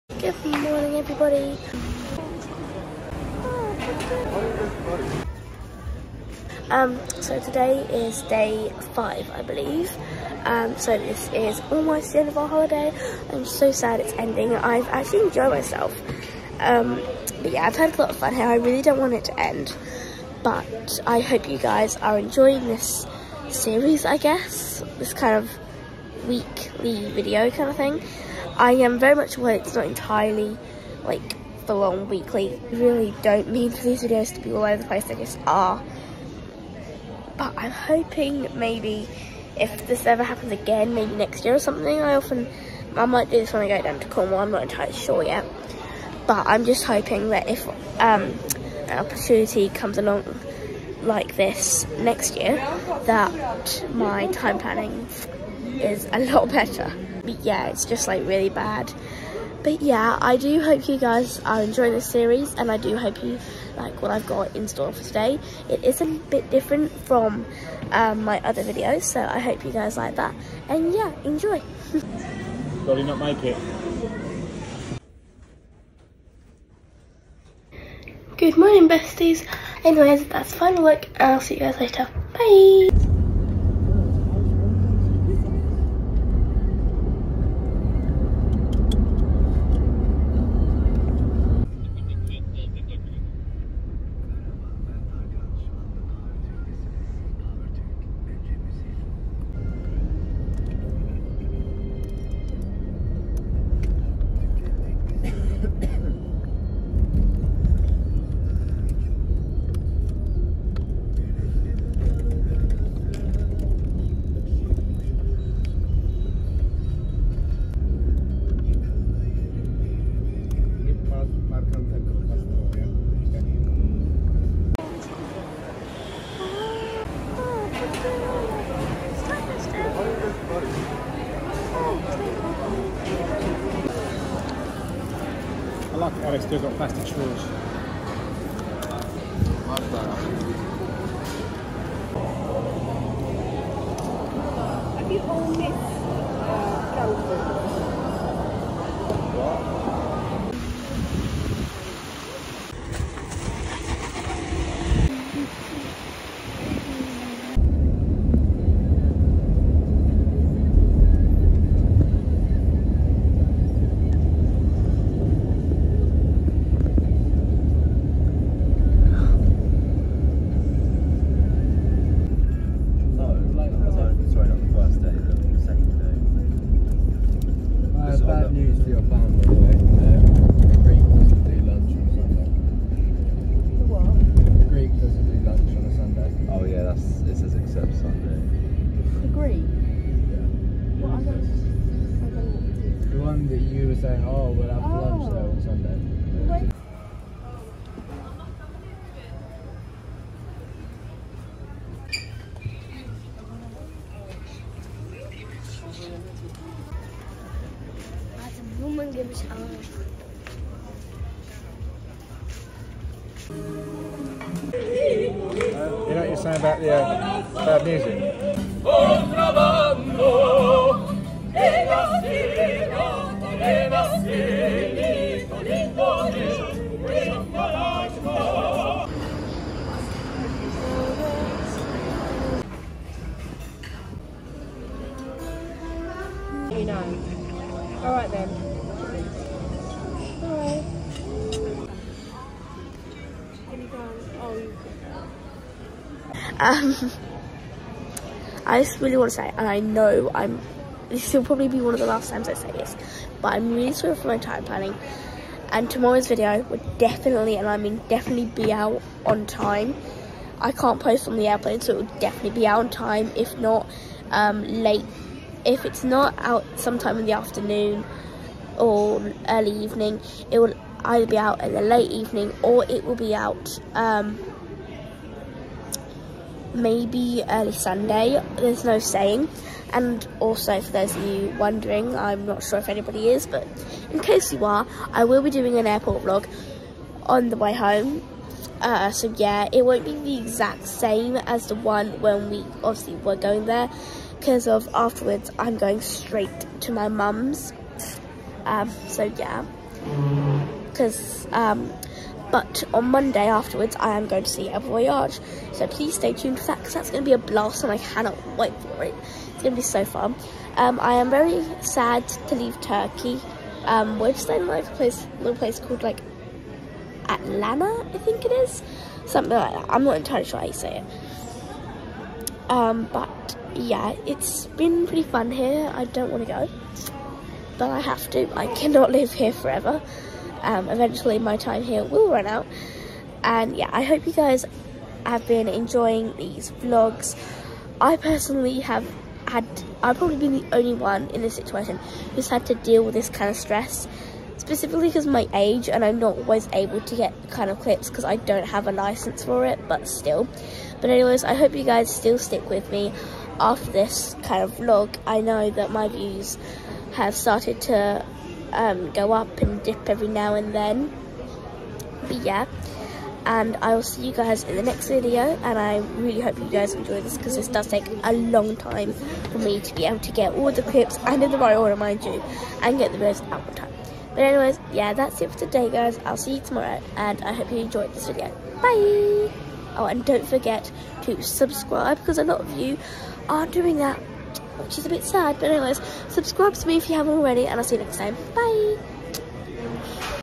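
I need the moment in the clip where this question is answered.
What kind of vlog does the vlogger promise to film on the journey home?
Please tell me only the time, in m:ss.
4:45.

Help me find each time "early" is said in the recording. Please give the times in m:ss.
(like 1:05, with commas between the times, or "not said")
4:29, 4:37.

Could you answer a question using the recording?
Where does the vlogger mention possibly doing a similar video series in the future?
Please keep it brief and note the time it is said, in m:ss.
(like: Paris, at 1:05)
Cornwall, at 0:44.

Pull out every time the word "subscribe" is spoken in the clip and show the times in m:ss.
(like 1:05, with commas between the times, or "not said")
6:21, 6:26.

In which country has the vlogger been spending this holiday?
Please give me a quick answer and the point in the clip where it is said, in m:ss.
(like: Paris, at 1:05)
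Turkey, at 5:12.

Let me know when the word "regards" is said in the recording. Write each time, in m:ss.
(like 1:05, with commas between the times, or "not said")
not said.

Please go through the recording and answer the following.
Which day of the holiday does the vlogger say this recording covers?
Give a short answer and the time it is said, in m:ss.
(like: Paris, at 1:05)
Day 5, at 0:08.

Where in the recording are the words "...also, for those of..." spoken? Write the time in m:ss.
4:40.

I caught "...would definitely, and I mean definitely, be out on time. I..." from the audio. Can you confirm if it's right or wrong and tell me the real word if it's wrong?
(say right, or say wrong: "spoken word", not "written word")
right.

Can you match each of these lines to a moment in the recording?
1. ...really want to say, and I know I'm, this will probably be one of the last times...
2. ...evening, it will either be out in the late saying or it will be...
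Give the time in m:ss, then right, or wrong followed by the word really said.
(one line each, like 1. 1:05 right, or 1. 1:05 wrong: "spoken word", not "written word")
1. 4:09 right
2. 4:29 wrong: "evening", not "saying".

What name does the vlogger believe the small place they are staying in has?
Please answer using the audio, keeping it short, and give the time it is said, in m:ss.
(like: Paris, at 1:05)
Atlanta, at 5:17.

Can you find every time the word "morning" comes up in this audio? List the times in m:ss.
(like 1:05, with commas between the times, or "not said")
0:00, 1:18.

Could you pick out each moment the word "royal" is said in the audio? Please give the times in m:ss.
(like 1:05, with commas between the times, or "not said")
not said.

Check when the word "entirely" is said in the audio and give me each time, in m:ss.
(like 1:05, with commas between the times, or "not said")
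0:29, 0:44, 5:20.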